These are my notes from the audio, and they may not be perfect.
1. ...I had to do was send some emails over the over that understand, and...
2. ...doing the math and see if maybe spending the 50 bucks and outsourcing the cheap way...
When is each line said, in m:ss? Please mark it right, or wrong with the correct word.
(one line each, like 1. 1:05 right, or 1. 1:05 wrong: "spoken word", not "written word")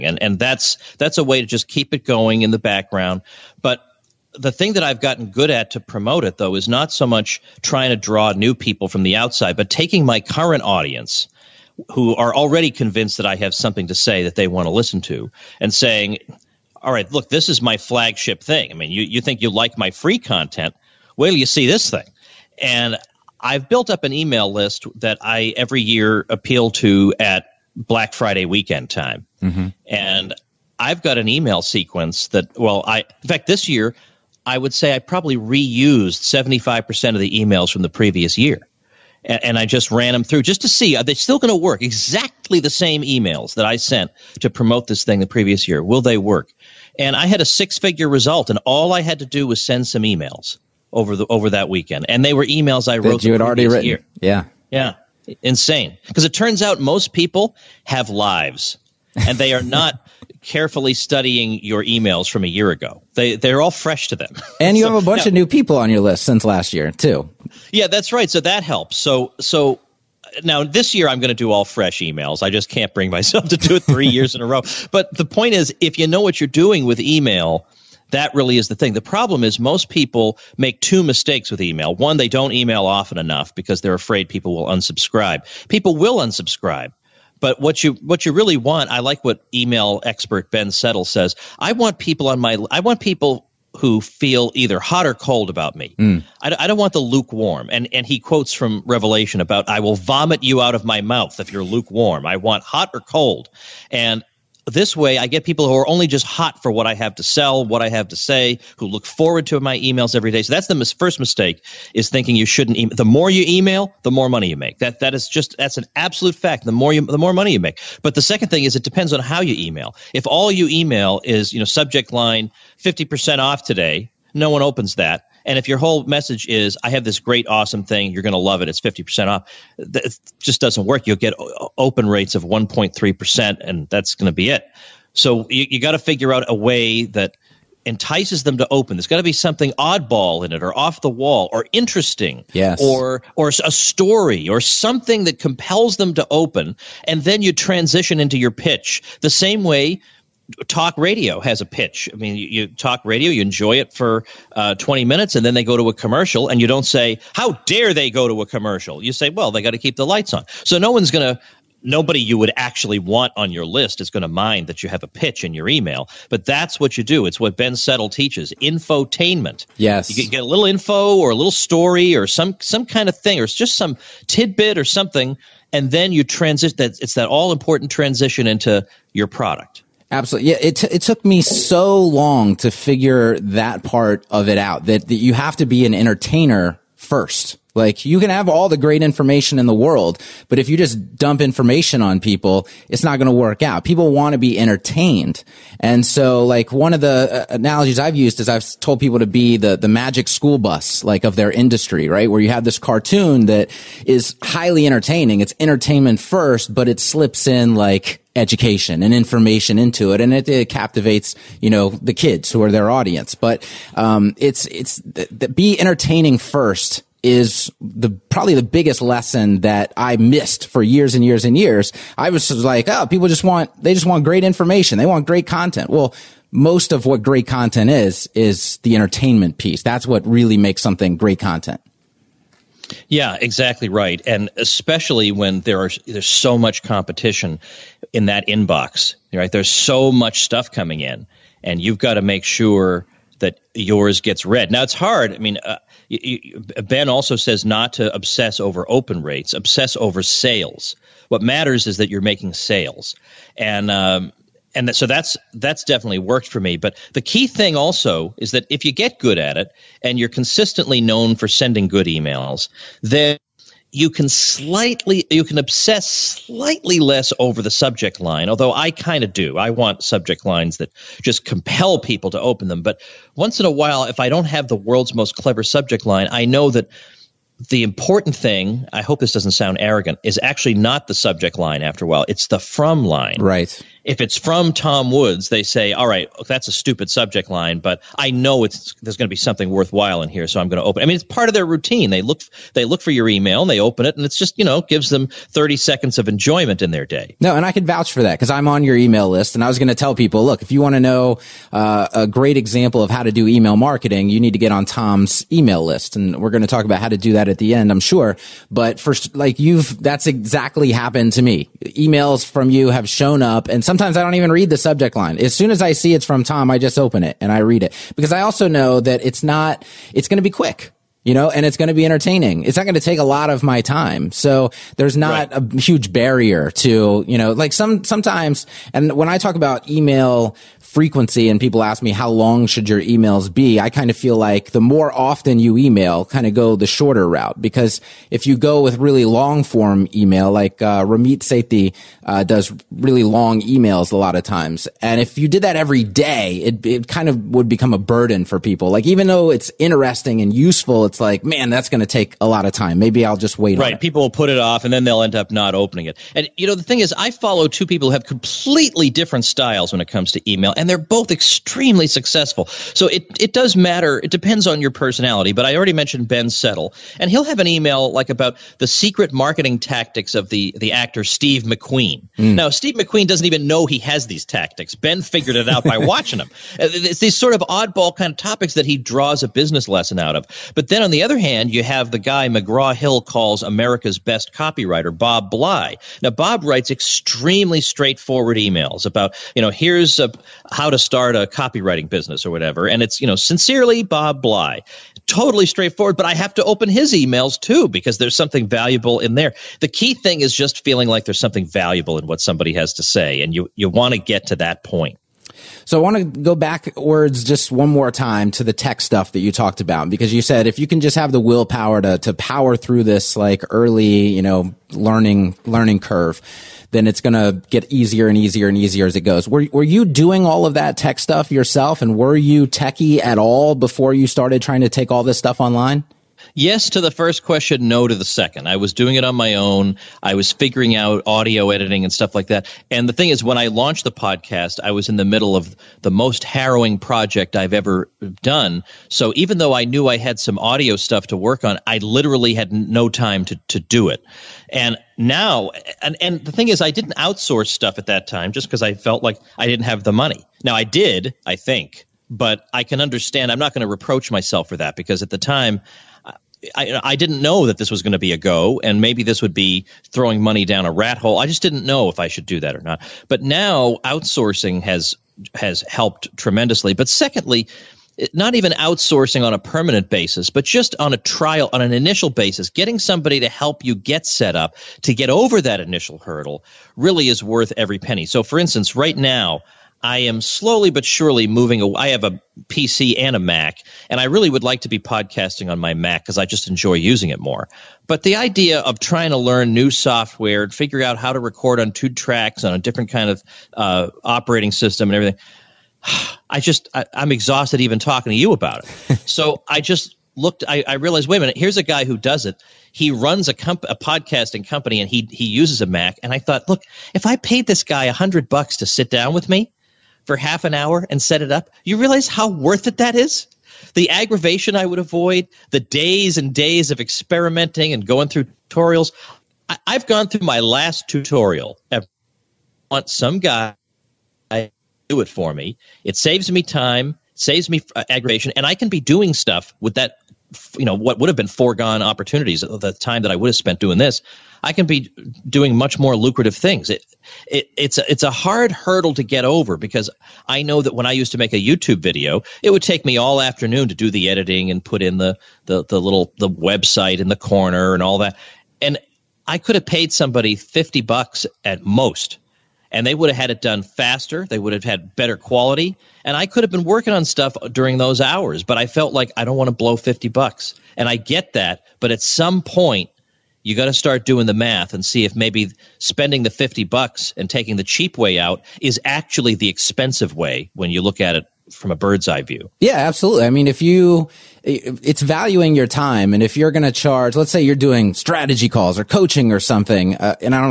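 1. 0:48 wrong: "weekend", not "understand"
2. 9:24 wrong: "taking", not "outsourcing".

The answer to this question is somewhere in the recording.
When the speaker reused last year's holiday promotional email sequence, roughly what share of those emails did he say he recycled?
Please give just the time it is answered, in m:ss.
0:36.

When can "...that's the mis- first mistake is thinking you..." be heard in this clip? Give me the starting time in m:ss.
1:50.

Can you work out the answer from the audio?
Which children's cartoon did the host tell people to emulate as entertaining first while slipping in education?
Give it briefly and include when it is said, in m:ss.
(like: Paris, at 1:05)
The Magic School Bus, at 3:19.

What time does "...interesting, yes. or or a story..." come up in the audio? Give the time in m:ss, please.
2:21.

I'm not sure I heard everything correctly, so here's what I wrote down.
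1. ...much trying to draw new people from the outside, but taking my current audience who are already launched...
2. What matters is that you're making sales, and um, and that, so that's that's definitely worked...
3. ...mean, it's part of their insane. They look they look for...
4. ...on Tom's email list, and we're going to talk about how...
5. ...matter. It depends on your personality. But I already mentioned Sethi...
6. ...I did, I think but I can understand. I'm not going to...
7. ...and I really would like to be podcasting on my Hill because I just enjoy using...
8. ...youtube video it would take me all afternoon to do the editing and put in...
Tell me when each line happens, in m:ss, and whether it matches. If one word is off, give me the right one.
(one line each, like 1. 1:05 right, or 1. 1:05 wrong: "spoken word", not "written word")
1. 0:07 wrong: "convinced", not "launched"
2. 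4:11 right
3. 4:51 wrong: "routine", not "insane"
4. 5:04 right
5. 6:03 wrong: "Ben", not "Sethi"
6. 7:30 right
7. 8:04 wrong: "Mac", not "Hill"
8. 9:01 right.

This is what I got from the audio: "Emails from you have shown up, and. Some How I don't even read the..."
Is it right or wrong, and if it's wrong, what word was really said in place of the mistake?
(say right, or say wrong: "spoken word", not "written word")
wrong: "Sometimes", not "How".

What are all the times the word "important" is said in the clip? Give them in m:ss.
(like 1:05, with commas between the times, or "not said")
2:57, 4:37.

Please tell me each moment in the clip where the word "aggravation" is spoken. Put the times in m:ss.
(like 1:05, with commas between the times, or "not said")
8:34, 8:48.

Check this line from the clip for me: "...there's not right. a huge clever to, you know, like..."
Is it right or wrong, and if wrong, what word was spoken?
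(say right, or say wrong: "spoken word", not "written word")
wrong: "barrier", not "clever".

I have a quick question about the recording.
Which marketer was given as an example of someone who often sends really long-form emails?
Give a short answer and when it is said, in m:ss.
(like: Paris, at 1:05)
Ramit Sethi, at 5:41.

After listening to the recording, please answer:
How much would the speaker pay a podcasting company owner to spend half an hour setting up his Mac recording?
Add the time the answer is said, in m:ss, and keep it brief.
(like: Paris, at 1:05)
$100, at 8:28.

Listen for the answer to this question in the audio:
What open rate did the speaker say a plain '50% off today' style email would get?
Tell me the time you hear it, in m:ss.
2:12.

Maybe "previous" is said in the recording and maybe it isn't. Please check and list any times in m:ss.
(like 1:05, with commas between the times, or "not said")
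0:37, 0:45.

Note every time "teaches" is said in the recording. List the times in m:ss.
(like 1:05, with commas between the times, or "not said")
2:48.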